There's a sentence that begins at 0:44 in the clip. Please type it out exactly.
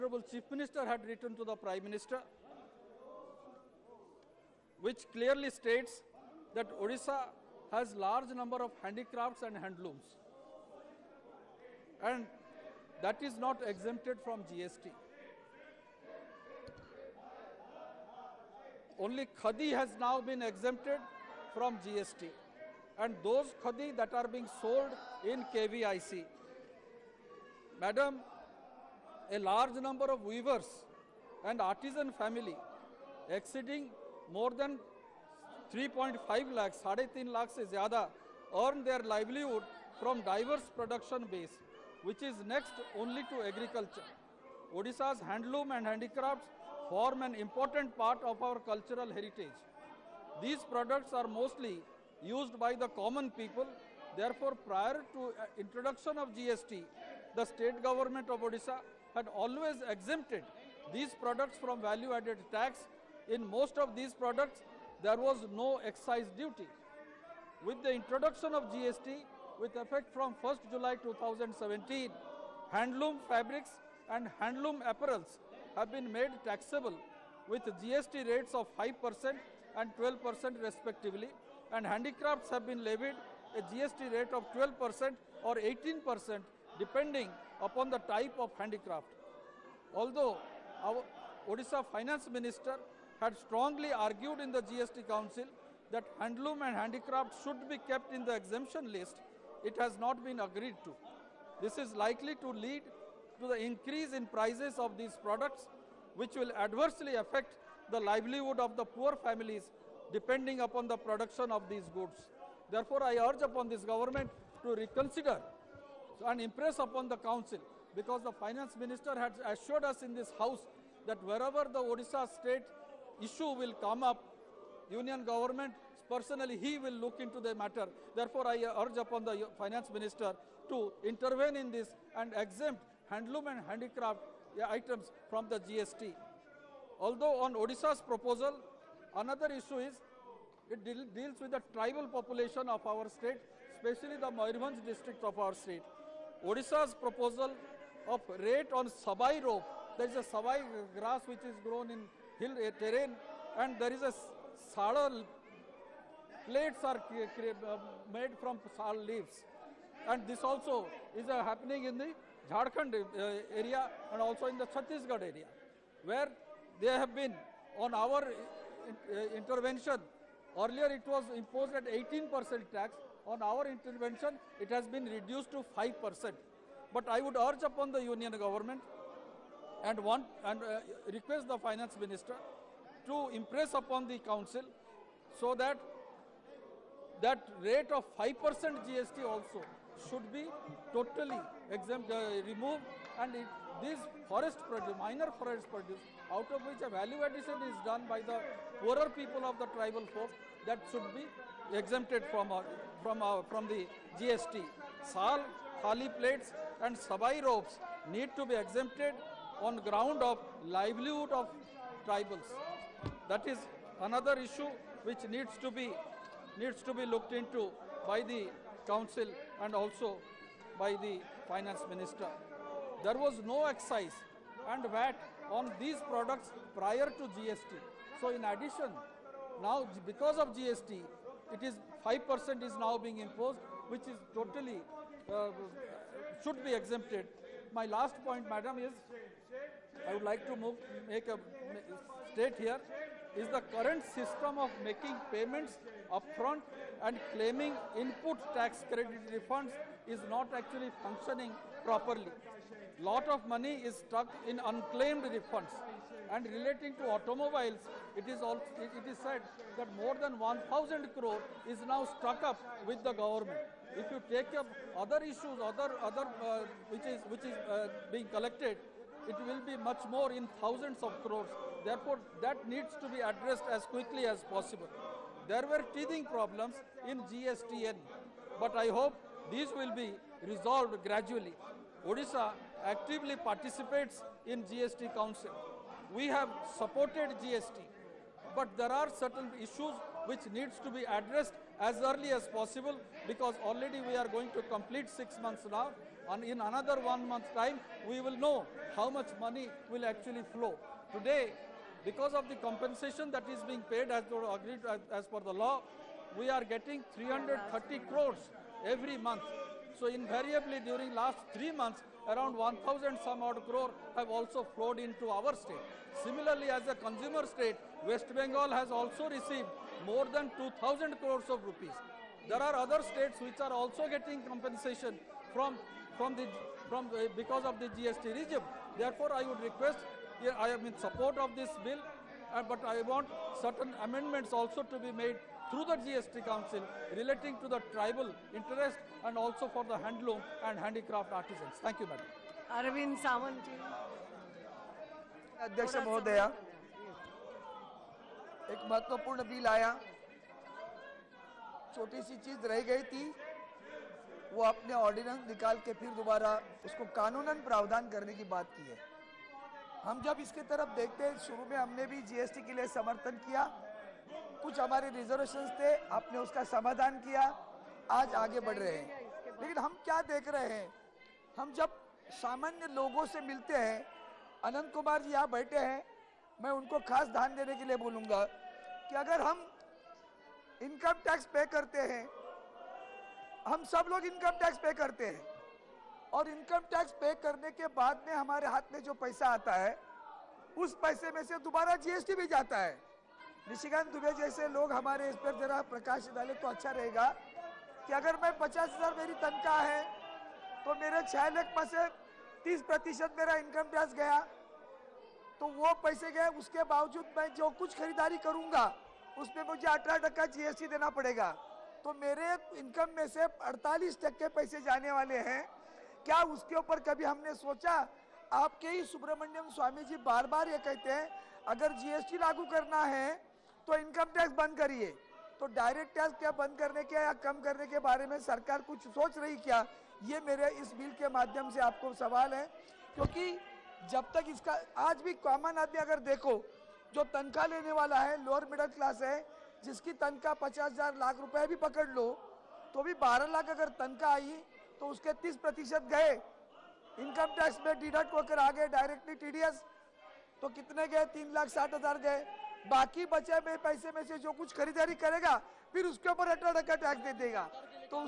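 Odisha's handloom and handicrafts form an important part of our cultural heritage.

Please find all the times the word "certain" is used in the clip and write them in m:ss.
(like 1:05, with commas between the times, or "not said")
4:49, 5:33.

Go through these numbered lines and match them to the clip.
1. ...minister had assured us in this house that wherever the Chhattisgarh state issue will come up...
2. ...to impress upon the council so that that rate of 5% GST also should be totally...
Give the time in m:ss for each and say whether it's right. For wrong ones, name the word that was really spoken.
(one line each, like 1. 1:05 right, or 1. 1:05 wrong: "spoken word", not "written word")
1. 1:58 wrong: "Odisha", not "Chhattisgarh"
2. 3:03 right.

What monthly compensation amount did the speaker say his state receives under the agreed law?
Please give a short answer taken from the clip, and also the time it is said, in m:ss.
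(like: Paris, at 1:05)
330 crores, at 5:07.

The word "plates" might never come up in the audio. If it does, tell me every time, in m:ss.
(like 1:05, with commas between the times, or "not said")
2:36, 3:26.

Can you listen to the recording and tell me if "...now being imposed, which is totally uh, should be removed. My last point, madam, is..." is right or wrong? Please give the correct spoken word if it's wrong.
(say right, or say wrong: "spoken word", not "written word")
wrong: "exempted", not "removed".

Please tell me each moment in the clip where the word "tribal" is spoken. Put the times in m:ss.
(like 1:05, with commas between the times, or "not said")
2:21, 3:19, 3:32, 5:37.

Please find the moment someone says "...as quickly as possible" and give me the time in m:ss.
4:33.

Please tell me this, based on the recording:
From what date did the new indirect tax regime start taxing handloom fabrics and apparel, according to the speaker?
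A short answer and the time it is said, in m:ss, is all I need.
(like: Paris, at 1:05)
1st July 2017, at 1:10.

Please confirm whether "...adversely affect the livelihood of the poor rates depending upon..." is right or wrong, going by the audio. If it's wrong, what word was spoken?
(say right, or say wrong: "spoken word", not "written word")
wrong: "families", not "rates".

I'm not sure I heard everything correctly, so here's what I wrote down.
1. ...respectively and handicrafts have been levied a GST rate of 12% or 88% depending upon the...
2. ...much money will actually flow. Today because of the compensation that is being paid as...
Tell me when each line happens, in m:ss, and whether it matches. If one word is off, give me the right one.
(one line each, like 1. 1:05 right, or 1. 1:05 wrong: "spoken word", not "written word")
1. 1:20 wrong: "18", not "88"
2. 4:59 right.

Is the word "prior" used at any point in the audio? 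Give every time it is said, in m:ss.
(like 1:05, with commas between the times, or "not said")
0:54, 3:46.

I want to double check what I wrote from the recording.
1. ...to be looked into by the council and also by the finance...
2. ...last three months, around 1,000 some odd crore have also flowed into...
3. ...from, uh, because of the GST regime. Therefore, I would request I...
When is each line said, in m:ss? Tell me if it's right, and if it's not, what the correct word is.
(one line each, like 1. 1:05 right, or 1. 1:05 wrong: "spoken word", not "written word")
1. 3:36 right
2. 5:11 right
3. 5:26 right.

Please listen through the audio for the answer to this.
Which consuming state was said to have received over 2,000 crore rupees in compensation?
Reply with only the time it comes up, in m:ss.
5:18.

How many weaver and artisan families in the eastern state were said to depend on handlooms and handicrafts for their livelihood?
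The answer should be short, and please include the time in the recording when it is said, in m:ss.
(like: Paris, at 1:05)
more than 3.5 lakh, at 0:33.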